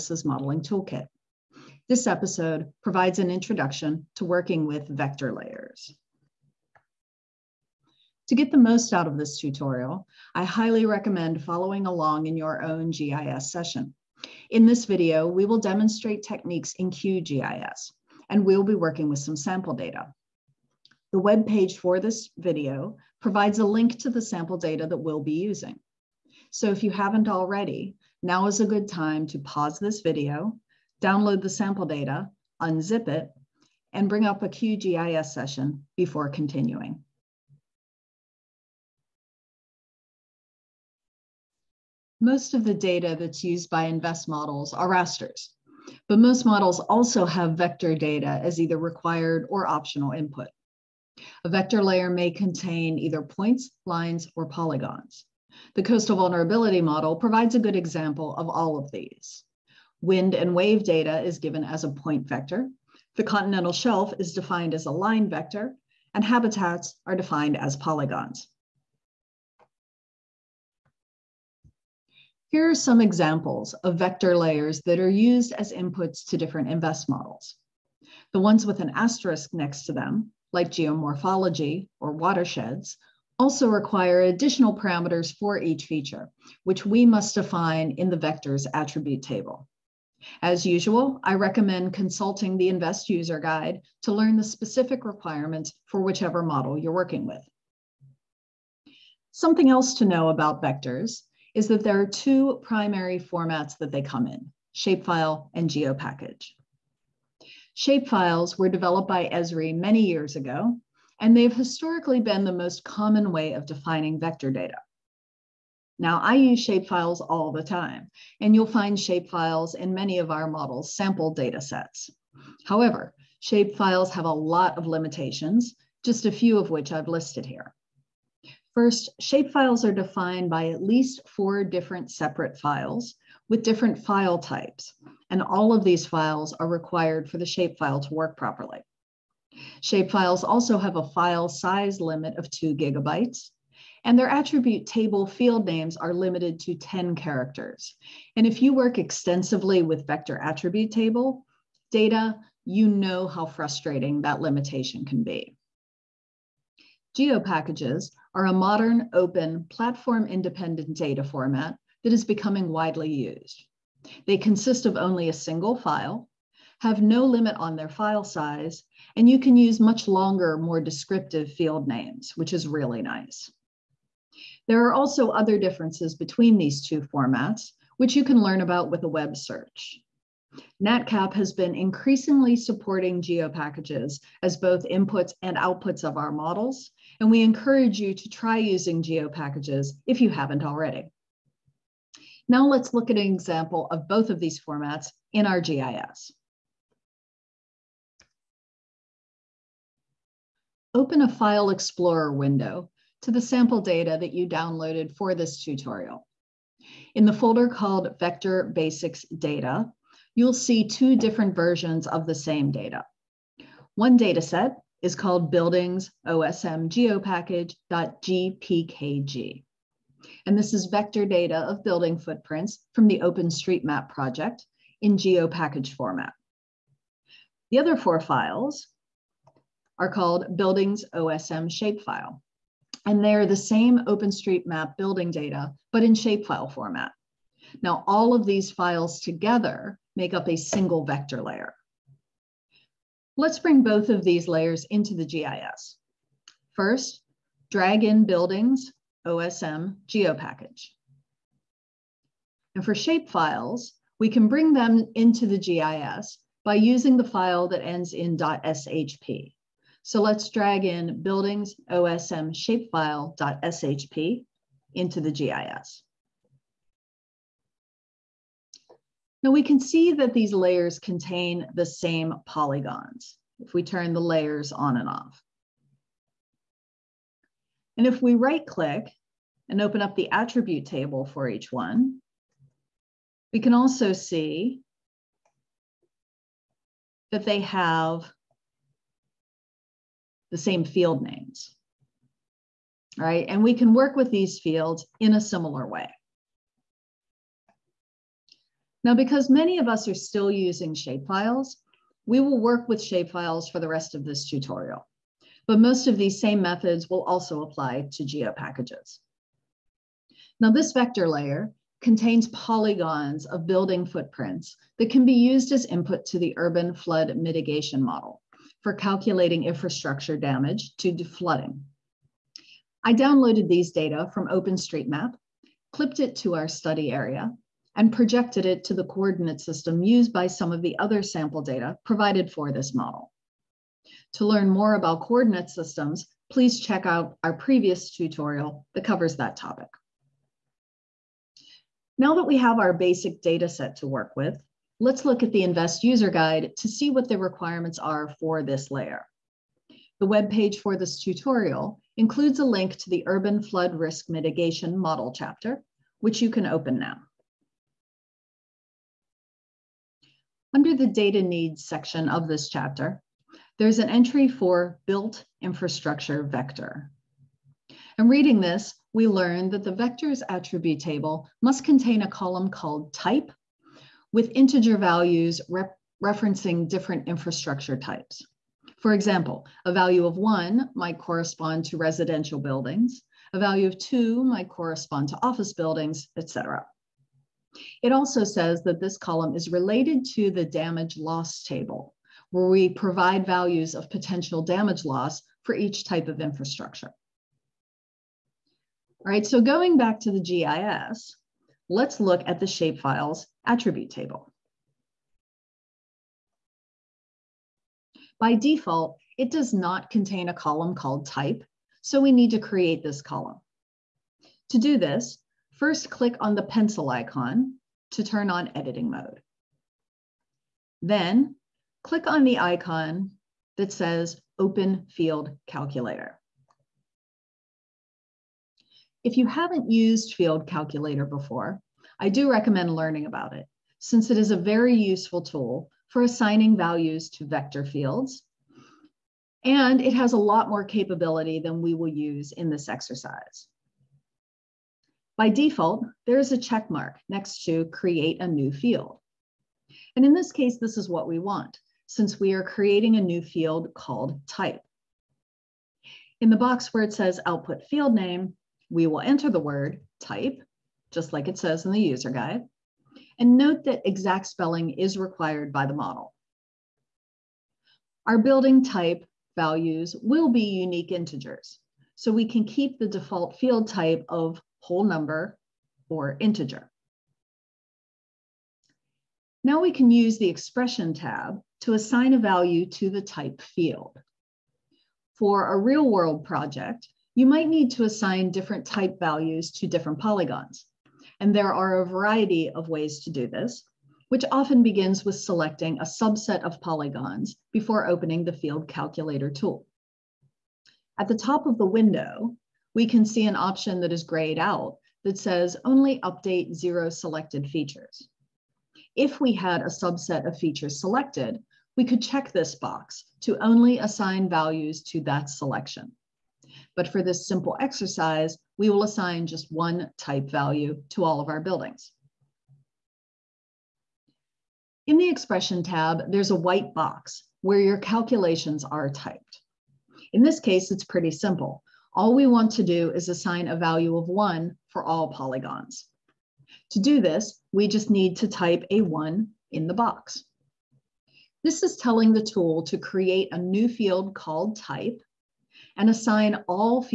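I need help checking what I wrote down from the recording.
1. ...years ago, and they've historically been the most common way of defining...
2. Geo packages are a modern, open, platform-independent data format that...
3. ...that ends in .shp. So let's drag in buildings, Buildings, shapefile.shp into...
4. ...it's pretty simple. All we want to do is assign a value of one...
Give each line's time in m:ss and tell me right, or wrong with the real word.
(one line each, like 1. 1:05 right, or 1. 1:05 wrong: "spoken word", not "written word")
1. 1:50 right
2. 2:37 right
3. 4:17 wrong: "OSM", not "Buildings"
4. 8:50 right.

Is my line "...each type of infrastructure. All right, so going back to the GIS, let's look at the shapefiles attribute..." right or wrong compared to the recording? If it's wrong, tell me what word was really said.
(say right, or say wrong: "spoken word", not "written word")
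right.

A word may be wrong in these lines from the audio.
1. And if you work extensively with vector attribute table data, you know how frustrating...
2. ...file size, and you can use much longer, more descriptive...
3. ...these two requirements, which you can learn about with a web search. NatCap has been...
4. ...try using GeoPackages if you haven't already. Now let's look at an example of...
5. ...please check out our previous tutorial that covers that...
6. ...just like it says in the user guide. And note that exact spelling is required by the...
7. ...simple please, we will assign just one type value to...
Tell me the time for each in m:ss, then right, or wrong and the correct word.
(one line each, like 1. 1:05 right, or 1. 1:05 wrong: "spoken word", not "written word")
1. 2:28 right
2. 2:47 right
3. 2:56 wrong: "formats", not "requirements"
4. 3:08 right
5. 5:36 right
6. 7:41 right
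7. 8:37 wrong: "exercise", not "please".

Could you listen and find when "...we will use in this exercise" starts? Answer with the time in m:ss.
7:21.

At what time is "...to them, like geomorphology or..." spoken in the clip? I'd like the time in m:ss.
1:19.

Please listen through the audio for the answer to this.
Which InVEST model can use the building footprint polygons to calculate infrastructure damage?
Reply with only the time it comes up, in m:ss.
5:16.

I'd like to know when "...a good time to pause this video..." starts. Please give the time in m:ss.
0:28.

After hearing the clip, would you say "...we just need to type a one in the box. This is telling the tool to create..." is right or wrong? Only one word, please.
right.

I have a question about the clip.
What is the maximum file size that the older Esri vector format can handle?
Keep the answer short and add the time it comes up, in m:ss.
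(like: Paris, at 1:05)
2 gigabytes, at 2:22.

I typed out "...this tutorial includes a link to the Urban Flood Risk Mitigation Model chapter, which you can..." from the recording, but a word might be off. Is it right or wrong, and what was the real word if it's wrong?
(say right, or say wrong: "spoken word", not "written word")
right.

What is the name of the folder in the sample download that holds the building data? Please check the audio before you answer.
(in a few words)
Vector Basics Data.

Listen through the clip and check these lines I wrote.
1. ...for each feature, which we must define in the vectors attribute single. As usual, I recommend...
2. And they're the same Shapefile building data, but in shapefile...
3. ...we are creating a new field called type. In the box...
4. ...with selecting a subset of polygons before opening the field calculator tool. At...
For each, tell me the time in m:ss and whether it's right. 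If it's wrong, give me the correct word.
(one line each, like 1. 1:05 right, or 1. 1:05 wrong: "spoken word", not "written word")
1. 1:25 wrong: "table", not "single"
2. 3:53 wrong: "OpenStreetMap", not "Shapefile"
3. 7:32 right
4. 8:15 right.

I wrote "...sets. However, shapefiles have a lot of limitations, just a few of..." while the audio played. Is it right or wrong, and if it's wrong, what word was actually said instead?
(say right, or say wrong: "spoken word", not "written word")
right.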